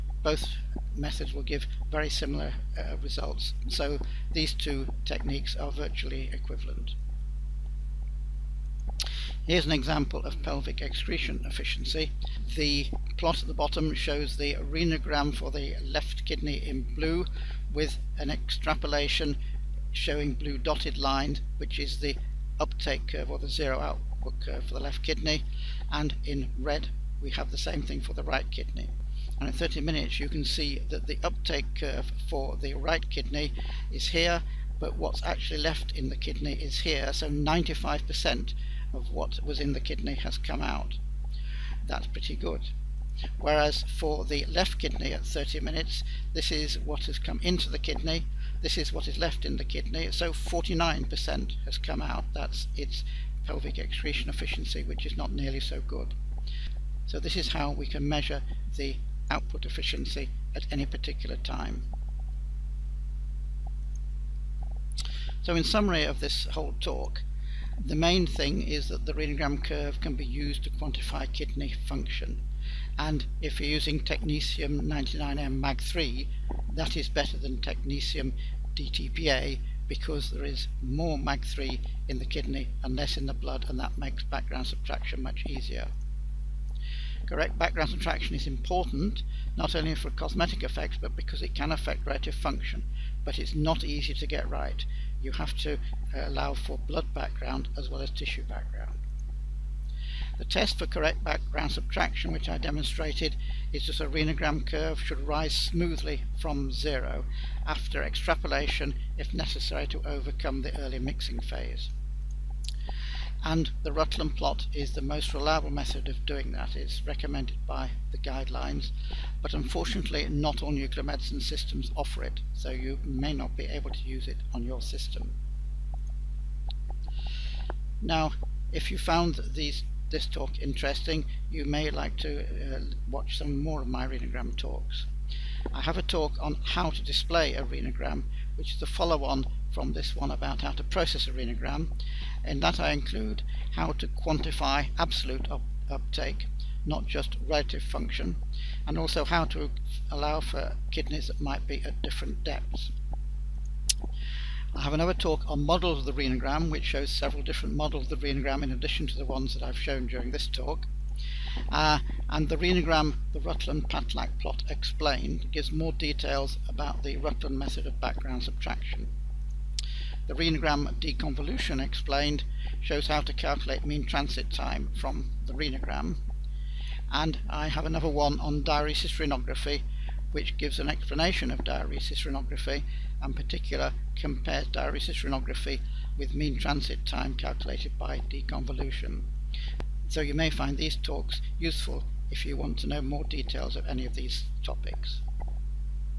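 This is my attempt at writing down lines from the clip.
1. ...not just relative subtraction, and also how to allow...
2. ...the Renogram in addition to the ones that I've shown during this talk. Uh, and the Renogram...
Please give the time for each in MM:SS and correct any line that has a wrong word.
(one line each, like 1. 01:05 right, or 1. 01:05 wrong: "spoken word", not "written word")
1. 02:26 wrong: "function", not "subtraction"
2. 02:38 right.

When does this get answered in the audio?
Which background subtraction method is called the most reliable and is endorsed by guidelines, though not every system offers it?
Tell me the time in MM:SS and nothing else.
01:53.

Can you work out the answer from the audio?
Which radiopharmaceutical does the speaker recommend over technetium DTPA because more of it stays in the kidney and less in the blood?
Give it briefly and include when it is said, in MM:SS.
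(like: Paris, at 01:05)
technetium 99m MAG3, at 01:13.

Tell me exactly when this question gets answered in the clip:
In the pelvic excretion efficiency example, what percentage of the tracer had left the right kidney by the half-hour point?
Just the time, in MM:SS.
00:37.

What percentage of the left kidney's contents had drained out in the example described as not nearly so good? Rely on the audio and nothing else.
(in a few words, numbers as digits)
49%.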